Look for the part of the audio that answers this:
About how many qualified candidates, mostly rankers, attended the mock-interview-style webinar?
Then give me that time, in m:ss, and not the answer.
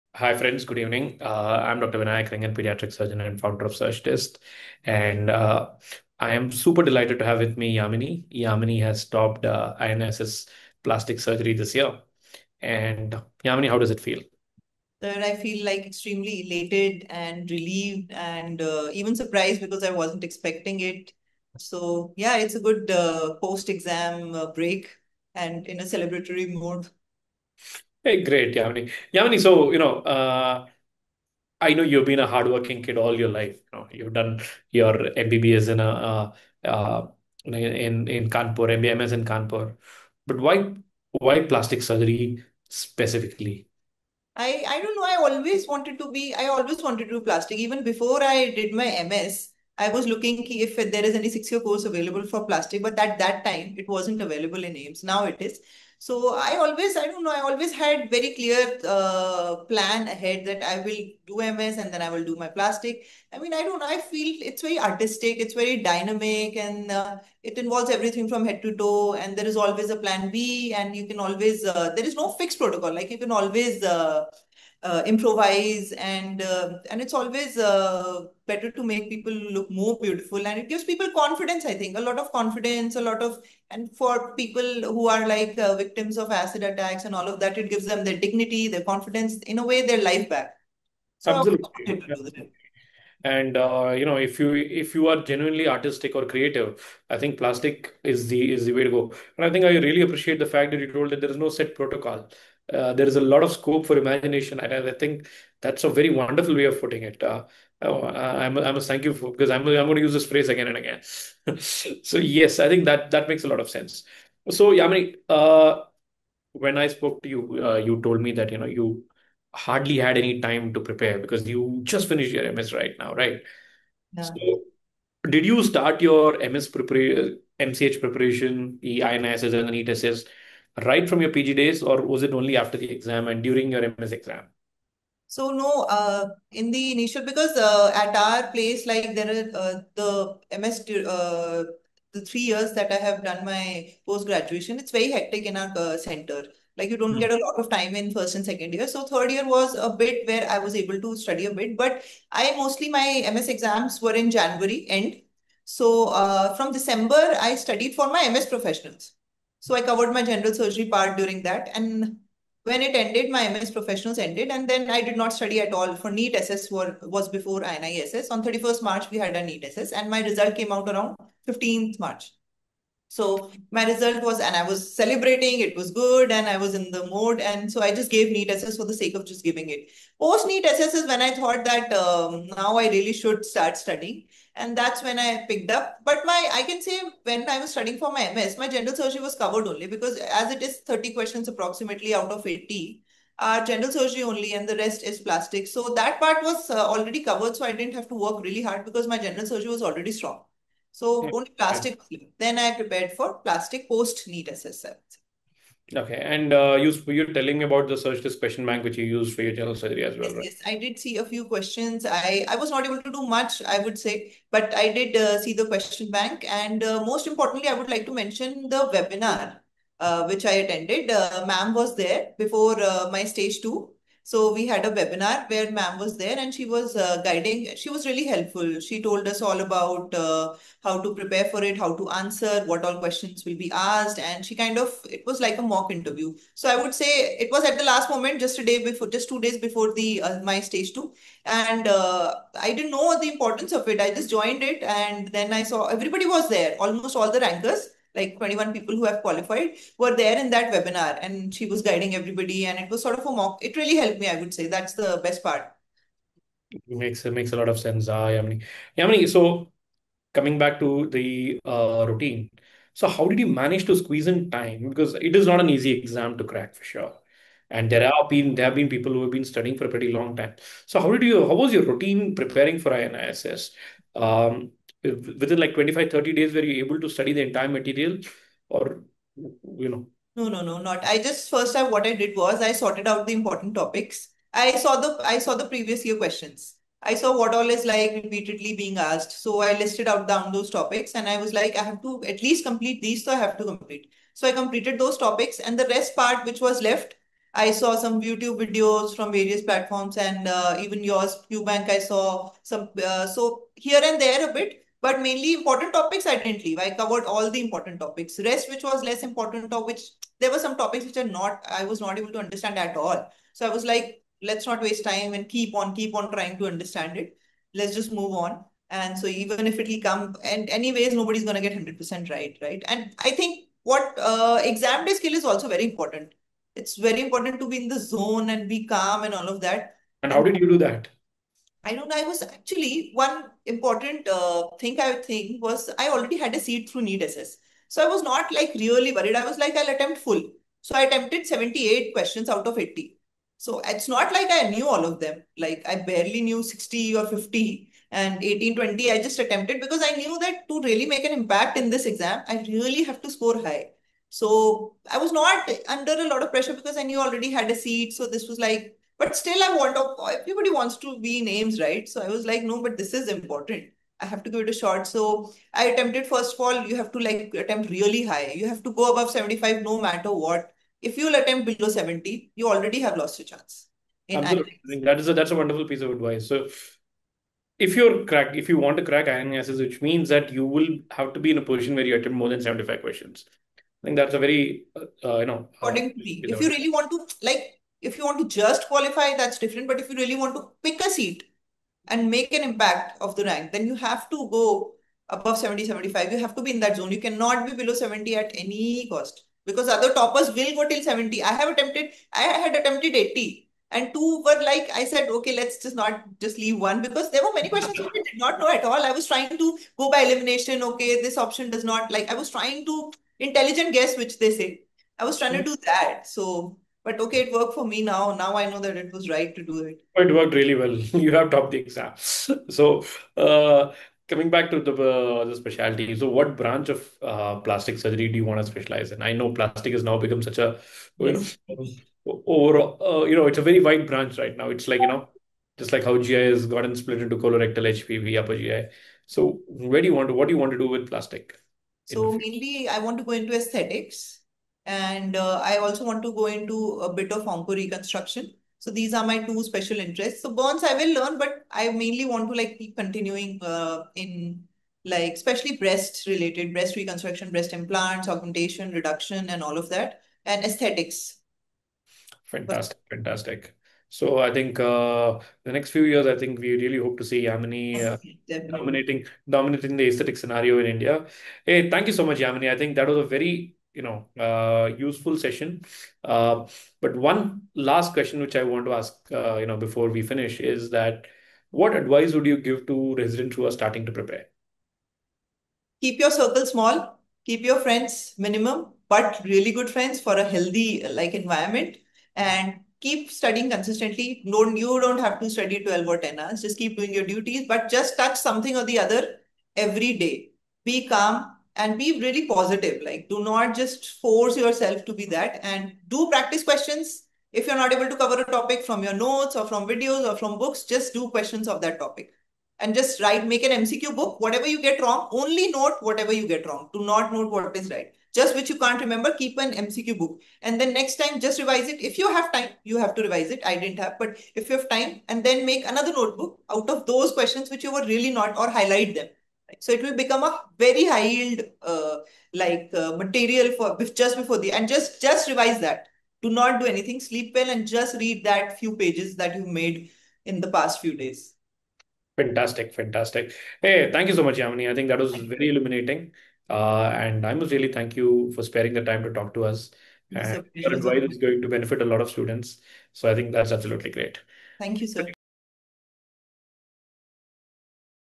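4:08.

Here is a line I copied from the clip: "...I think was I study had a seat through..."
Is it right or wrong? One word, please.
wrong.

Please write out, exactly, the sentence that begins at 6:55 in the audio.
do that so but okay, it worked for me now.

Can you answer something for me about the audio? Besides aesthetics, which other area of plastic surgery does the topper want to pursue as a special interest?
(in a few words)
Onco reconstruction.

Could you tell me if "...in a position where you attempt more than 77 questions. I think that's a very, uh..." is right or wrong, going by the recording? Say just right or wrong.
wrong.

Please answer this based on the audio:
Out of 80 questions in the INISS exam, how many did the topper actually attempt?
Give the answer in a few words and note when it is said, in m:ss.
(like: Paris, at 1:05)
78, at 5:41.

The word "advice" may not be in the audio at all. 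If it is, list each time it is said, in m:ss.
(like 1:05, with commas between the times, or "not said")
6:16, 8:01, 9:10.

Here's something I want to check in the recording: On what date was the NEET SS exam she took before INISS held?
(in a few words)
31st March.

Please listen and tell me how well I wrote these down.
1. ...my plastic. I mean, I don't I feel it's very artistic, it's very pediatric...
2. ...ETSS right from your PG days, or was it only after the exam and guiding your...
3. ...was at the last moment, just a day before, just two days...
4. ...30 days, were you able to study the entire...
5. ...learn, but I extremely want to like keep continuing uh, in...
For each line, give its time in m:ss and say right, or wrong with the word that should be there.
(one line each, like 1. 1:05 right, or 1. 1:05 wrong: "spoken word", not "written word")
1. 1:02 wrong: "dynamic", not "pediatric"
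2. 2:09 wrong: "during", not "guiding"
3. 3:57 right
4. 4:36 right
5. 7:31 wrong: "mainly", not "extremely".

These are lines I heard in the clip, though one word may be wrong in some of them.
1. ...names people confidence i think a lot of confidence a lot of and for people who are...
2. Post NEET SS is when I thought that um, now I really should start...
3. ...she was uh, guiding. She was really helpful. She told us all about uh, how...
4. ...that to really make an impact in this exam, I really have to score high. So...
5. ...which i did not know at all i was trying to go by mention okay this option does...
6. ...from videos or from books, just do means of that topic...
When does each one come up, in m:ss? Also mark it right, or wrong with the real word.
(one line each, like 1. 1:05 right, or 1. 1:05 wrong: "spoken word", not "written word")
1. 1:20 wrong: "gives", not "names"
2. 3:00 right
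3. 3:46 right
4. 5:50 right
5. 6:47 wrong: "elimination", not "mention"
6. 8:29 wrong: "questions", not "means".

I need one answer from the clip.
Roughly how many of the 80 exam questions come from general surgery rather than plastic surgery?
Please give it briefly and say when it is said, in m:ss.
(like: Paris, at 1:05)
30, at 3:10.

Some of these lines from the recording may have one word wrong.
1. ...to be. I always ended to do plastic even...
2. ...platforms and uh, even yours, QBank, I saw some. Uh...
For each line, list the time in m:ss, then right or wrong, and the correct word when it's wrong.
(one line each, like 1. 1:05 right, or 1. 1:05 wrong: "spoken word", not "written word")
1. 0:45 wrong: "wanted", not "ended"
2. 4:59 right.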